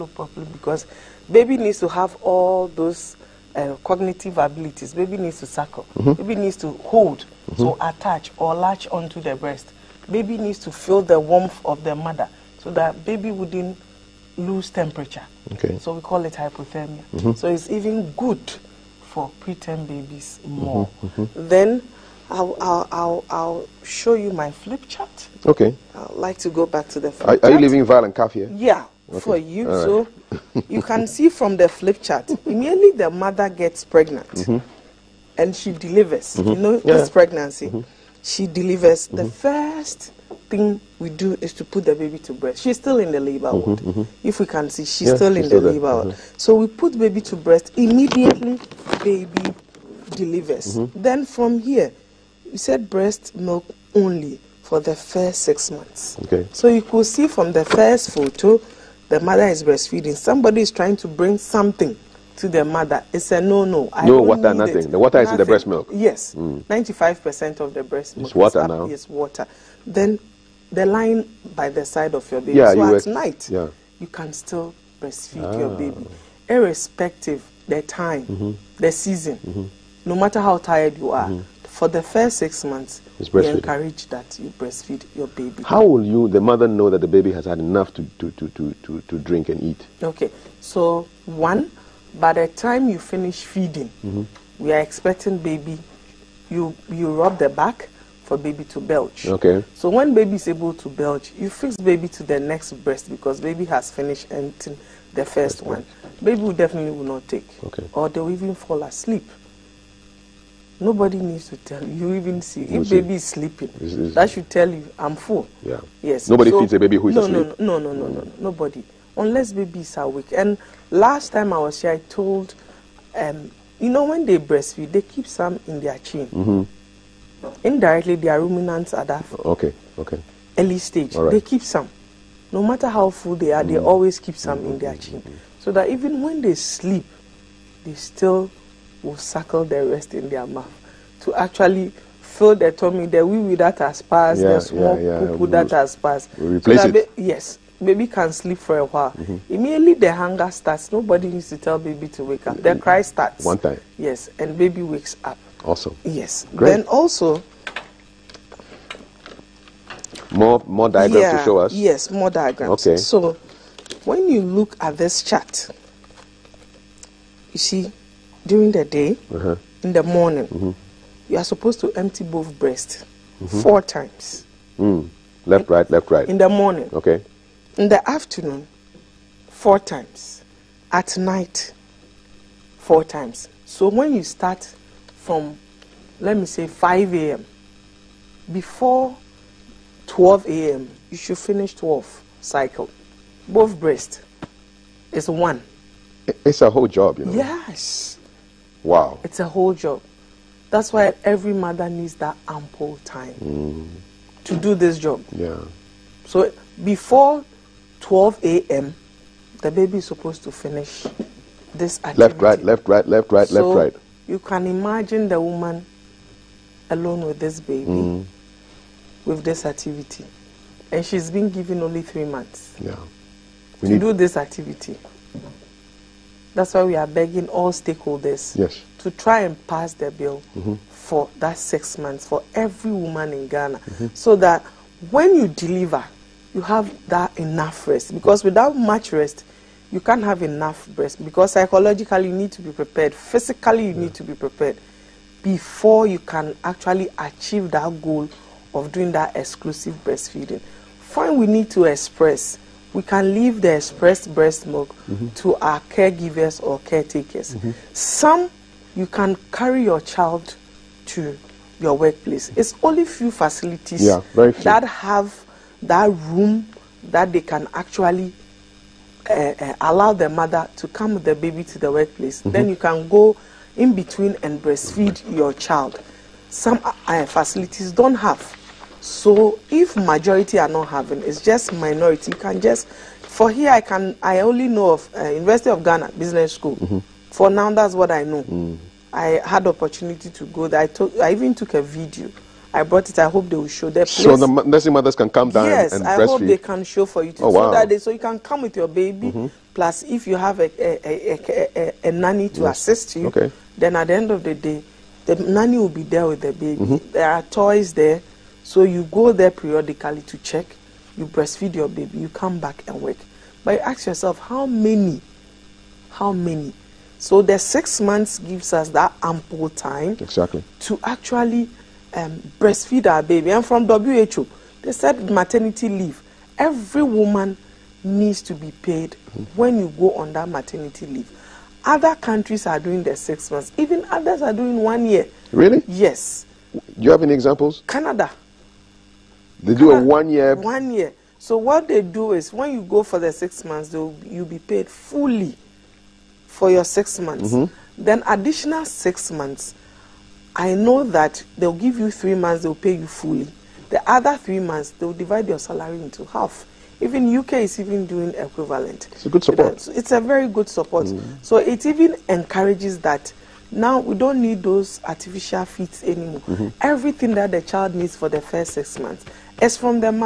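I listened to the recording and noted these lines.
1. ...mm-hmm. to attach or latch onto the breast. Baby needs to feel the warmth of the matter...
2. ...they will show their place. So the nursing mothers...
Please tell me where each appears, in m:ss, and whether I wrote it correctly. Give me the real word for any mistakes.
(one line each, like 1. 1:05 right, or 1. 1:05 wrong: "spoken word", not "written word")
1. 0:07 wrong: "mother", not "matter"
2. 4:53 right.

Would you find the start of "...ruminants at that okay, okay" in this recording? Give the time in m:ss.
2:08.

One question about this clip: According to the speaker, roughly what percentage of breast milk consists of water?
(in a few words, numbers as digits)
95%.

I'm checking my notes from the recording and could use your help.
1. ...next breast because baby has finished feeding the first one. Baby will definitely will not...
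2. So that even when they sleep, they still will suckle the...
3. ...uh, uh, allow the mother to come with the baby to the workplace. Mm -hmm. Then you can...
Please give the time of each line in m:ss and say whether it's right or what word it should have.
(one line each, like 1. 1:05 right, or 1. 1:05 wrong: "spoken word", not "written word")
1. 1:42 wrong: "emptying", not "feeding"
2. 2:15 right
3. 4:29 right.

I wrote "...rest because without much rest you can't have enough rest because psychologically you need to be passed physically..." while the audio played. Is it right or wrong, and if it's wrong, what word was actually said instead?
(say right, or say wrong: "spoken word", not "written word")
wrong: "prepared", not "passed".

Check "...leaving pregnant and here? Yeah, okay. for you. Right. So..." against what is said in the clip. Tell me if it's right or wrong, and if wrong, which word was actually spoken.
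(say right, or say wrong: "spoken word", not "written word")
wrong: "violent", not "pregnant".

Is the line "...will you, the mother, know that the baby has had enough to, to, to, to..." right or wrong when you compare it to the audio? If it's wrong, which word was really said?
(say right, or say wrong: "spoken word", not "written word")
right.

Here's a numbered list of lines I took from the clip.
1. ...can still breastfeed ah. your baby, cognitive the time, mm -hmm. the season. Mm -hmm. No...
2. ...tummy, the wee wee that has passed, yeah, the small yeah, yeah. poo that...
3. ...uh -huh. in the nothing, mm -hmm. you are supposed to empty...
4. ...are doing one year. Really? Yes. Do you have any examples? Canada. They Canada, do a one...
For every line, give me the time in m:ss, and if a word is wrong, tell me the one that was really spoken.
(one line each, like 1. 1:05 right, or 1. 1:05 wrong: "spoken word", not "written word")
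1. 1:14 wrong: "irrespective", not "cognitive"
2. 2:22 right
3. 2:49 wrong: "morning", not "nothing"
4. 5:34 right.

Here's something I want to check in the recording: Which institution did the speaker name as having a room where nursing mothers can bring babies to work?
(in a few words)
University of Ghana Business School.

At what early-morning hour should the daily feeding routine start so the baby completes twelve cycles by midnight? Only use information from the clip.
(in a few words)
5 a.m.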